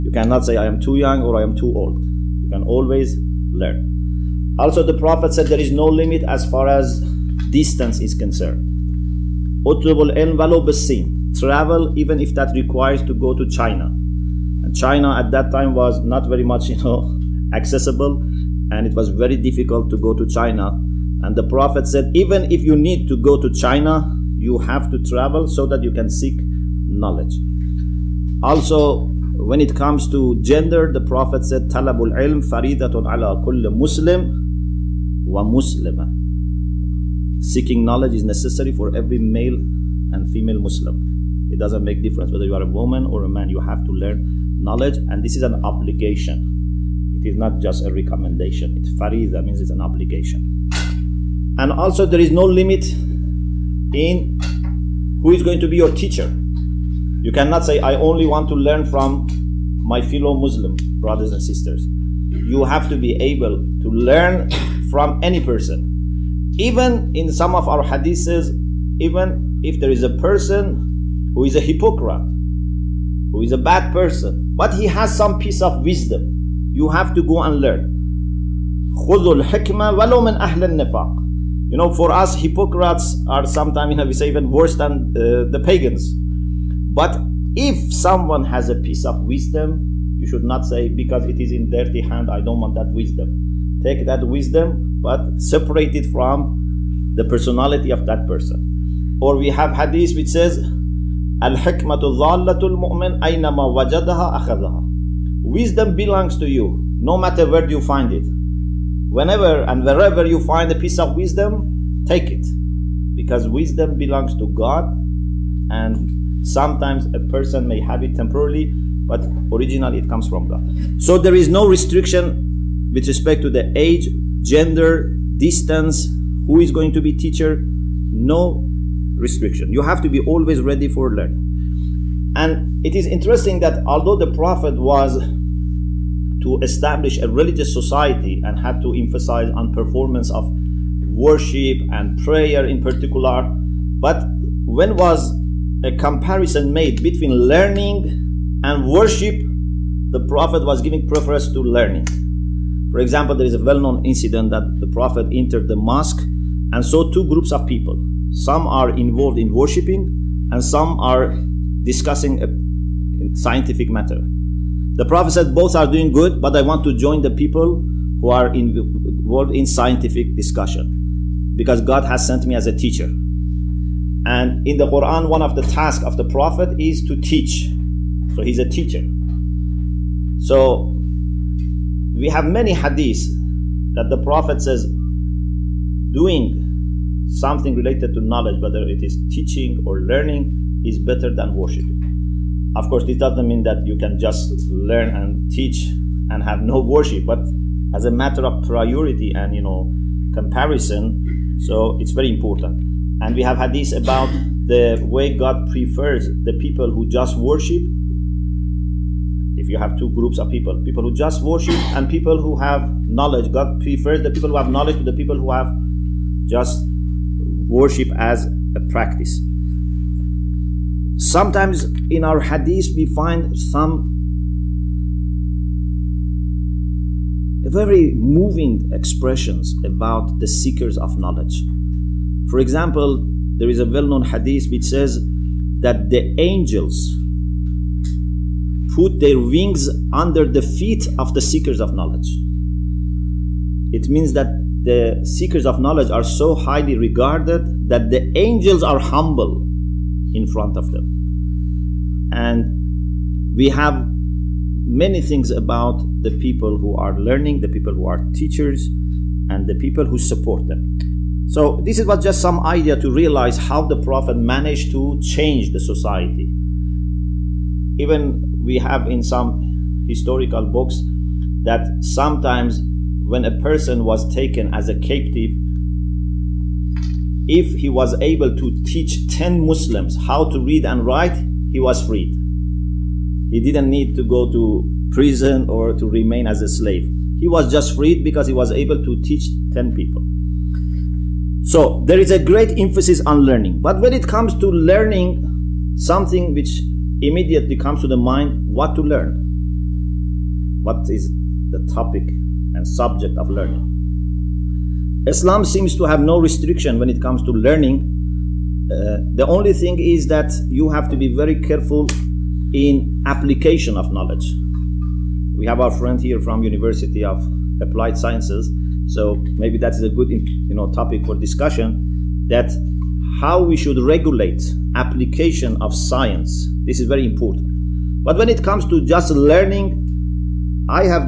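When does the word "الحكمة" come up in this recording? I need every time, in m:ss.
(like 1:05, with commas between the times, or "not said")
1:19, 1:41.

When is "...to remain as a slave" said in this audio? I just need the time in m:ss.
4:45.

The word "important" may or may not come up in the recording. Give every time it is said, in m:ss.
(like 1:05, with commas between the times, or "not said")
3:22, 5:27.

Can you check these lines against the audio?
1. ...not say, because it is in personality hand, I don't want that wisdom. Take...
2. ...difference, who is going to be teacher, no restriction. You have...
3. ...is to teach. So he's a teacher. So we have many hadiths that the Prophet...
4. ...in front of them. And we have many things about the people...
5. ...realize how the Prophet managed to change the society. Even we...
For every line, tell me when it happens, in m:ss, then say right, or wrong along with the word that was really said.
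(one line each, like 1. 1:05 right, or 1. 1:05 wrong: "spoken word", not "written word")
1. 1:30 wrong: "dirty", not "personality"
2. 2:05 wrong: "distance", not "difference"
3. 2:56 right
4. 4:10 right
5. 4:23 right.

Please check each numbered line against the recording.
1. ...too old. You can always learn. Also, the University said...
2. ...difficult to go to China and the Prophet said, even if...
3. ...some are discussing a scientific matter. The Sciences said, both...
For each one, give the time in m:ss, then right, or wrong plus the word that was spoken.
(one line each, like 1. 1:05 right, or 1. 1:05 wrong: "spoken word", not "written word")
1. 0:01 wrong: "Prophet", not "University"
2. 0:19 right
3. 2:40 wrong: "Prophet", not "Sciences".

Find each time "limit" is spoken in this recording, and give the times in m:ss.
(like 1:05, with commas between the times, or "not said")
0:05, 0:52.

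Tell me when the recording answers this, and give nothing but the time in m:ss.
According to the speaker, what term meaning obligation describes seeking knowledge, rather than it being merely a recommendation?
0:48.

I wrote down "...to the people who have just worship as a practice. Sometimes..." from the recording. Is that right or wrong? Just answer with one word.
right.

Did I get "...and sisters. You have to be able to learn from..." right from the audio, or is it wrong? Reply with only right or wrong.
right.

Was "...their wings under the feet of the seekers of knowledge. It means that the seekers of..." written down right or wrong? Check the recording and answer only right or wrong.
right.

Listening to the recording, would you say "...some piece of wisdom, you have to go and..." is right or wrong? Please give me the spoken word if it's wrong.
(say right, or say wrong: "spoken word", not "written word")
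right.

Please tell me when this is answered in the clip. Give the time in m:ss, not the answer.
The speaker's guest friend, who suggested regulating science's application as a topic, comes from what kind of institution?
5:16.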